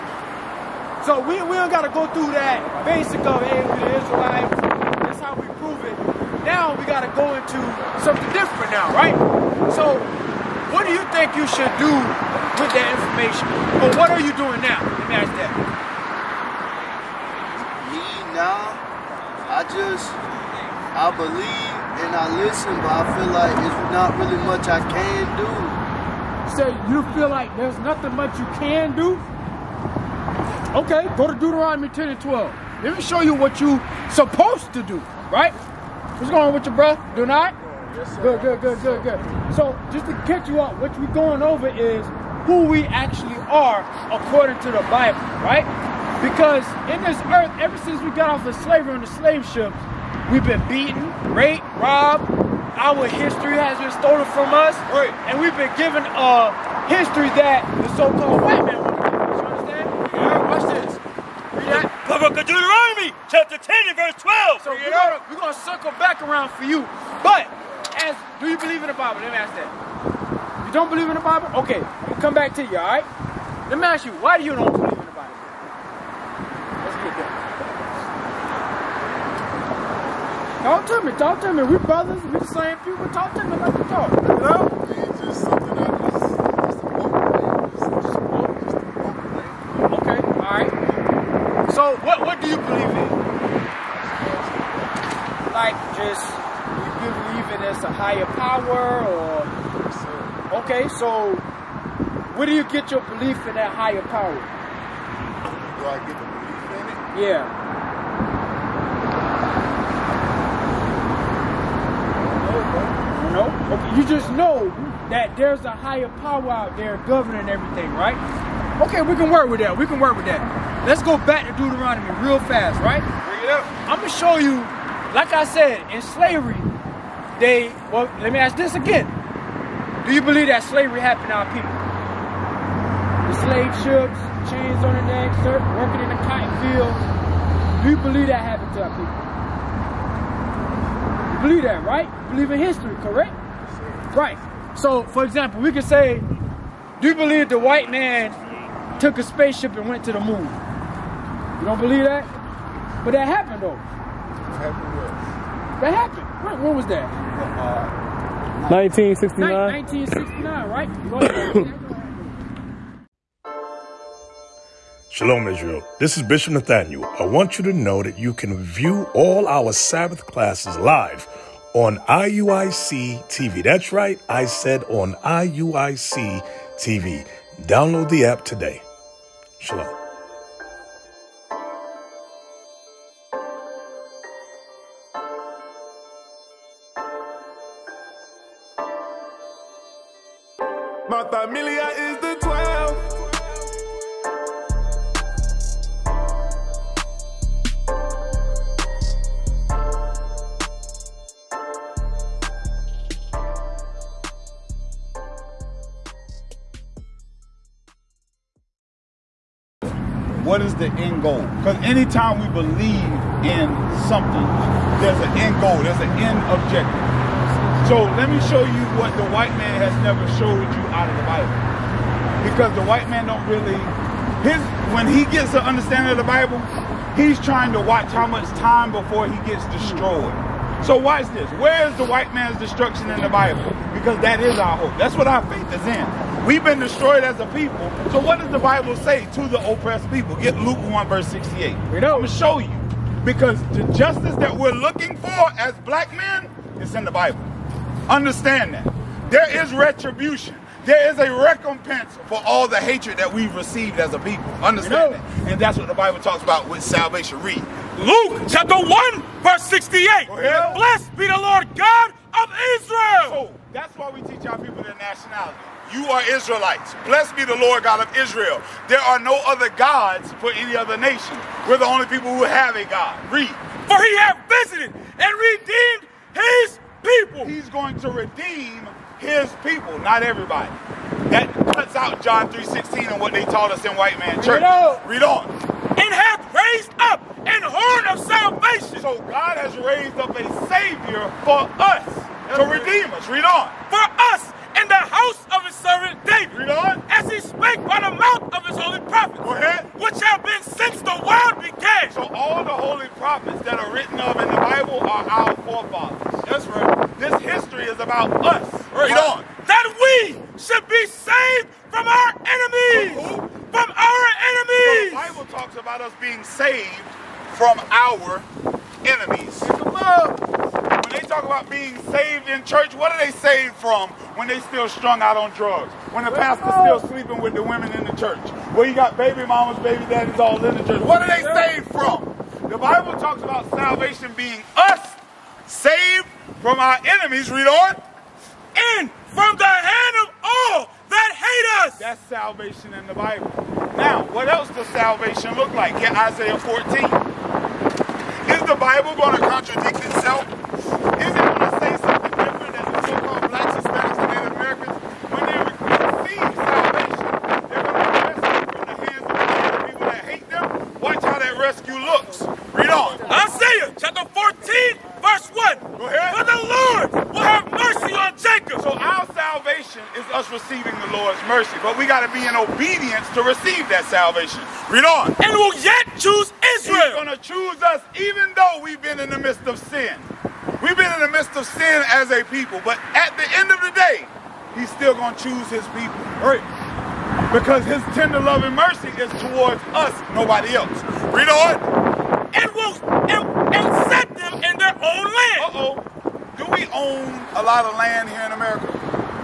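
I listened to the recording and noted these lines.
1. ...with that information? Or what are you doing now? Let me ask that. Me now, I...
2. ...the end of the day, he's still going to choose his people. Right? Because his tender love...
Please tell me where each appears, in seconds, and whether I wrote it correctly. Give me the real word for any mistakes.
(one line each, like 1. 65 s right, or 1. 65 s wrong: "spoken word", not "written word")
1. 12 s right
2. 383 s right.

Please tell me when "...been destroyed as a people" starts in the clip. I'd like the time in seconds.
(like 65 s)
236 s.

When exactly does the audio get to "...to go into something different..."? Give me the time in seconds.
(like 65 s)
7 s.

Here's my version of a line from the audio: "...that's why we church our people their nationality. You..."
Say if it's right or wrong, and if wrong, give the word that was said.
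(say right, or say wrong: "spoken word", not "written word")
wrong: "teach", not "church".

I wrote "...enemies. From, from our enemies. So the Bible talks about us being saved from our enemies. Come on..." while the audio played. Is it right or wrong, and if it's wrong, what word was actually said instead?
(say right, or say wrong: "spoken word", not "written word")
right.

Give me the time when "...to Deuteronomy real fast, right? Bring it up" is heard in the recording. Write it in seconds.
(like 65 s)
121 s.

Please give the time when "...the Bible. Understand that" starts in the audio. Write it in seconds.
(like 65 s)
247 s.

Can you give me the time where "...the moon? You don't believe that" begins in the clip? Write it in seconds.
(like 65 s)
150 s.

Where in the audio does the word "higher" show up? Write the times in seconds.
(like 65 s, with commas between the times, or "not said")
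97 s, 103 s, 115 s.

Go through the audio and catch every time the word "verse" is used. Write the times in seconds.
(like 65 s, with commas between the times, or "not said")
63 s, 241 s, 259 s.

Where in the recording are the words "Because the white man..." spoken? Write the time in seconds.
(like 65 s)
222 s.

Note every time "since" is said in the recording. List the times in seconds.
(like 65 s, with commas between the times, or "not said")
47 s, 300 s.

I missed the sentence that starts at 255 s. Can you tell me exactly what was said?
And that's what the Bible talks about with salvation.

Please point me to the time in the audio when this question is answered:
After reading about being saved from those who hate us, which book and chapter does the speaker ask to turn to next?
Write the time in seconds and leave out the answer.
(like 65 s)
346 s.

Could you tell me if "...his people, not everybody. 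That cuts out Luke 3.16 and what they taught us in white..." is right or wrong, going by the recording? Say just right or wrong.
wrong.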